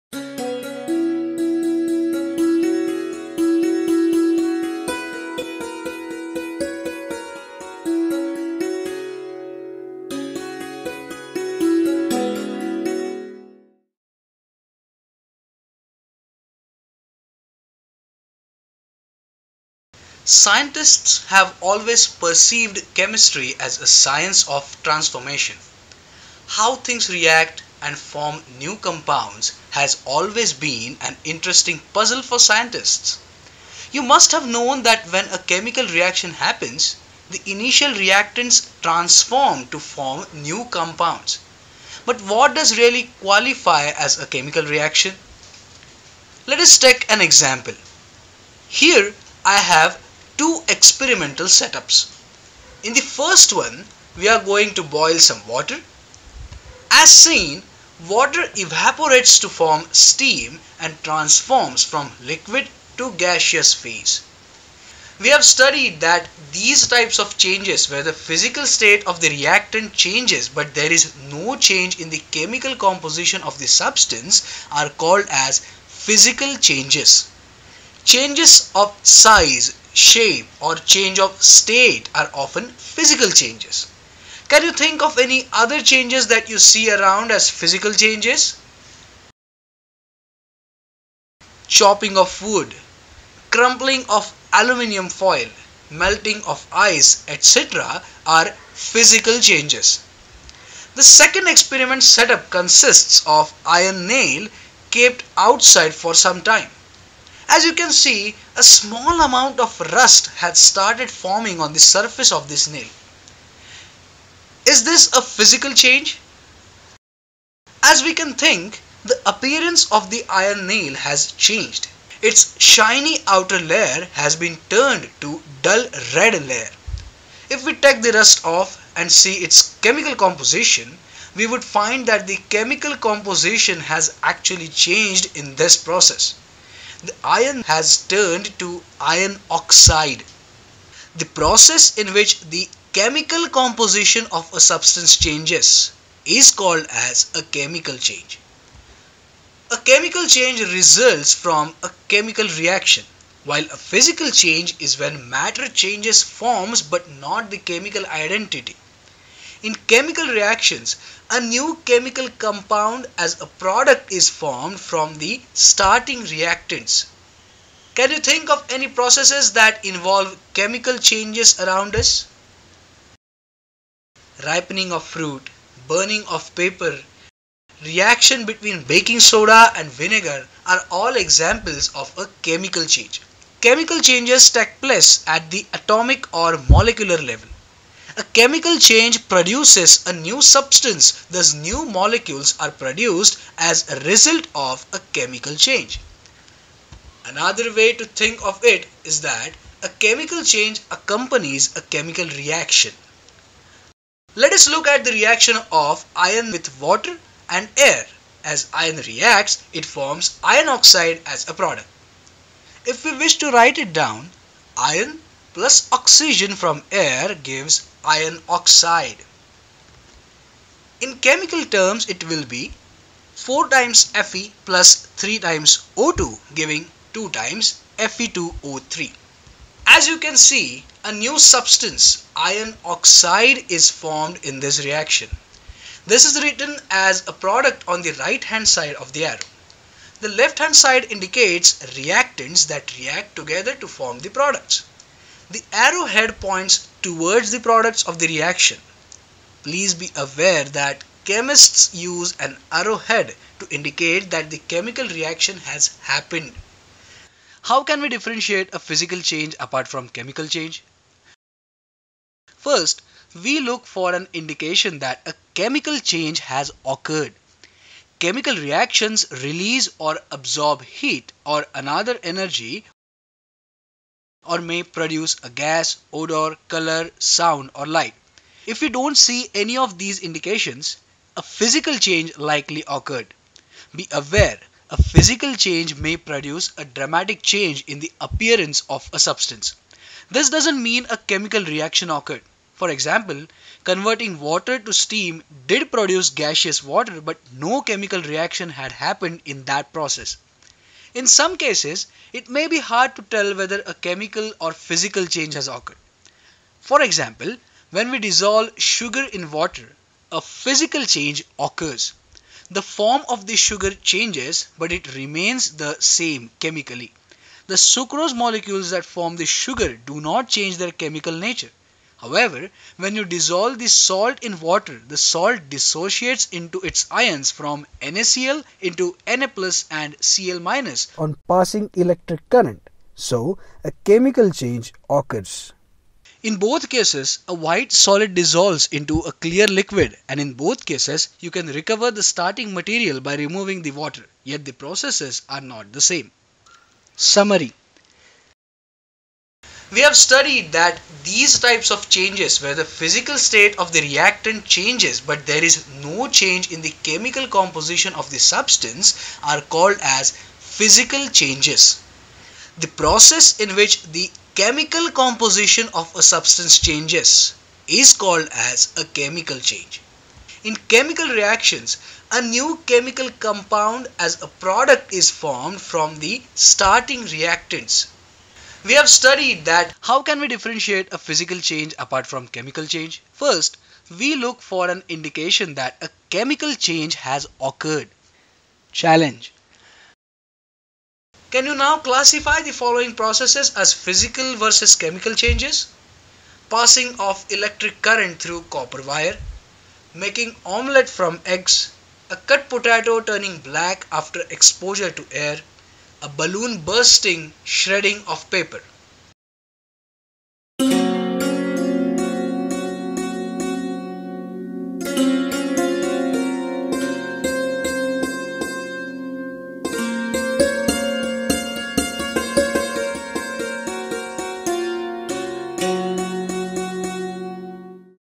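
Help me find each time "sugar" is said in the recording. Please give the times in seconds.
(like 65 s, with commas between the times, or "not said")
308 s, 313 s, 319 s.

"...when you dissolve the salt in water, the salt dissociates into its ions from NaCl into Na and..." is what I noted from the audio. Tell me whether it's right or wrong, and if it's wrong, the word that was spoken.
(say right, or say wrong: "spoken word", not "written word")
right.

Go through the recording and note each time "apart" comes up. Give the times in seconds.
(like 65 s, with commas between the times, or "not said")
259 s, 381 s.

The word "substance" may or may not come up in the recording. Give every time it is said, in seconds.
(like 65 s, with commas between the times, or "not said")
73 s, 144 s, 190 s, 231 s, 289 s, 358 s, 366 s.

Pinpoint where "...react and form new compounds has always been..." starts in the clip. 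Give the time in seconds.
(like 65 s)
27 s.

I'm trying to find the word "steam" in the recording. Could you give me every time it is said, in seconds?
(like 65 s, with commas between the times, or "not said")
59 s, 294 s.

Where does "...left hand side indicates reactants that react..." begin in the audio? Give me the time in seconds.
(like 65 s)
240 s.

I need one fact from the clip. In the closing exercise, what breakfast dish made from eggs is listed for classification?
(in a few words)
omelette.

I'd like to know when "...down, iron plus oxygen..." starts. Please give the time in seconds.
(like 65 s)
213 s.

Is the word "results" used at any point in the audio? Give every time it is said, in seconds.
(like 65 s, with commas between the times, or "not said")
150 s, 194 s.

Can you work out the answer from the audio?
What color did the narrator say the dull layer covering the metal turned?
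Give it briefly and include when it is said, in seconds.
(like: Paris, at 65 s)
red, at 125 s.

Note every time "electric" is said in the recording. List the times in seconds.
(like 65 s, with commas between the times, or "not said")
331 s, 397 s.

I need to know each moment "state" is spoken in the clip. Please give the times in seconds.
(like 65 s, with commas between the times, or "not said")
68 s, 81 s, 353 s.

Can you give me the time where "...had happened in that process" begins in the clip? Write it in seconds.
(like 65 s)
298 s.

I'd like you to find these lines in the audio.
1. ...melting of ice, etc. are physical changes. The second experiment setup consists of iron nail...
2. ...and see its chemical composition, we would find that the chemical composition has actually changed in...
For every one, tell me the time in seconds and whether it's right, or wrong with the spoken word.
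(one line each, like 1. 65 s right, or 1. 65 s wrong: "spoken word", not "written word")
1. 95 s right
2. 128 s right.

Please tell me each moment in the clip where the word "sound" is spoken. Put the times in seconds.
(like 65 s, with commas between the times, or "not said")
277 s.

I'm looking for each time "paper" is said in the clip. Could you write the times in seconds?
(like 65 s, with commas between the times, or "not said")
176 s, 408 s.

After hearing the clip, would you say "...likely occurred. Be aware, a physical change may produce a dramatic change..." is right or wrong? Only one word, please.
right.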